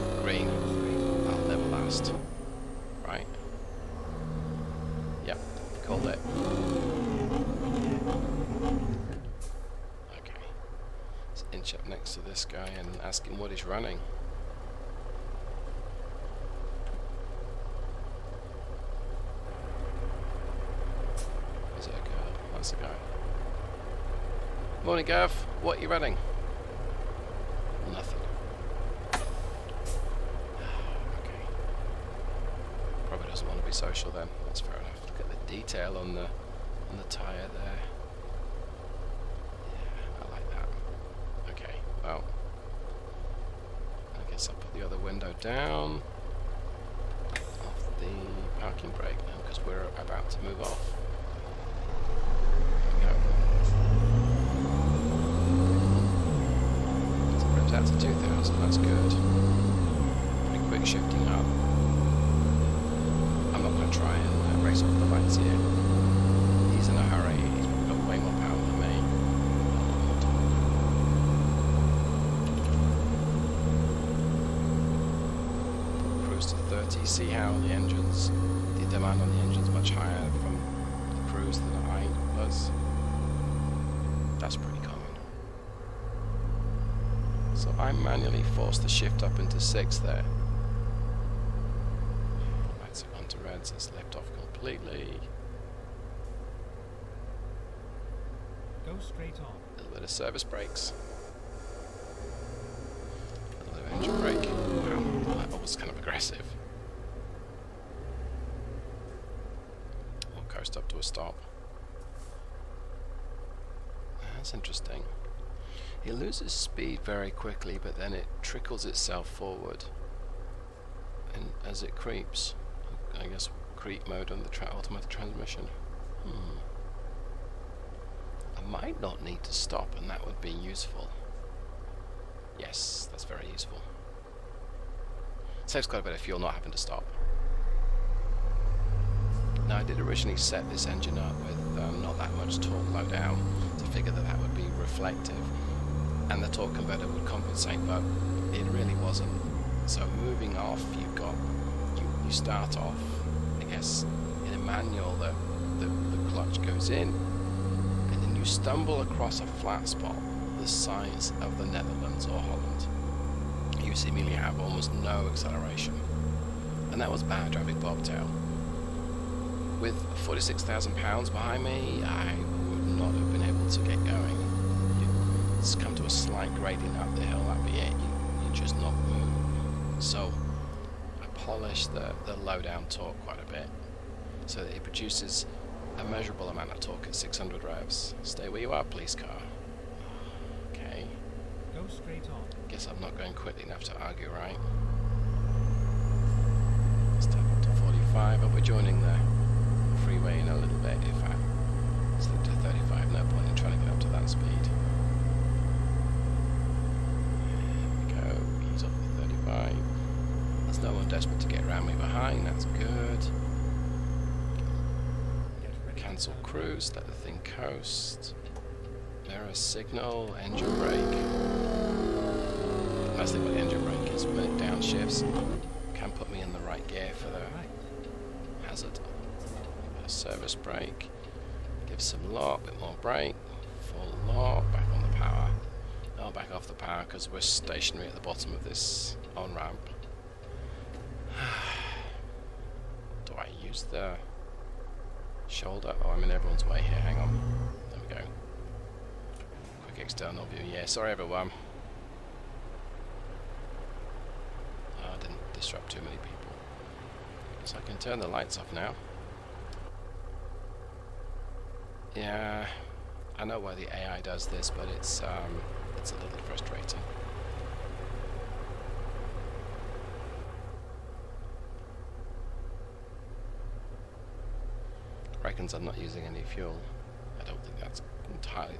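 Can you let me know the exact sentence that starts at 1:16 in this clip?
Cruise to 30, see how the engines, the demand on the engines much higher from the cruise than I was.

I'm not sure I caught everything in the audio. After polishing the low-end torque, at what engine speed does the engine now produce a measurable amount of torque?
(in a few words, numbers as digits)
600 revs.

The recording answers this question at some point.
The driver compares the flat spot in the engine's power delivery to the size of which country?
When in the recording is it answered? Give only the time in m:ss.
2:41.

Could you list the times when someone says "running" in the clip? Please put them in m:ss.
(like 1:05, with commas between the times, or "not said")
0:13, 0:25.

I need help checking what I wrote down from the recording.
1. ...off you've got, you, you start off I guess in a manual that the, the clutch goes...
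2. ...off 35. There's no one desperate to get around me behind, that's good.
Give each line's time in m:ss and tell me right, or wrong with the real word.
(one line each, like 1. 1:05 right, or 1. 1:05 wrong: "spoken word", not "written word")
1. 2:30 right
2. 3:28 right.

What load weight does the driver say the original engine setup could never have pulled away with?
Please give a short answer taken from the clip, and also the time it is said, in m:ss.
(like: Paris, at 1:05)
£46,000, at 2:50.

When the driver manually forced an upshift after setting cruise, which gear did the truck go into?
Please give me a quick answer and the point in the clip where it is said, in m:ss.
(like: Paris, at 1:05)
6, at 1:29.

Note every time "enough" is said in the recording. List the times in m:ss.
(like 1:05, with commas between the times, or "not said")
0:34, 3:13.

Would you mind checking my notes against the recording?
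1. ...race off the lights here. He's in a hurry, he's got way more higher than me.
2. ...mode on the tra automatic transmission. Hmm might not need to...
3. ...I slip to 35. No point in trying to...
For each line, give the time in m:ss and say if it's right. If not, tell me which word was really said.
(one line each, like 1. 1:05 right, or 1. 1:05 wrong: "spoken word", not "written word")
1. 1:04 wrong: "power", not "higher"
2. 2:04 right
3. 3:21 right.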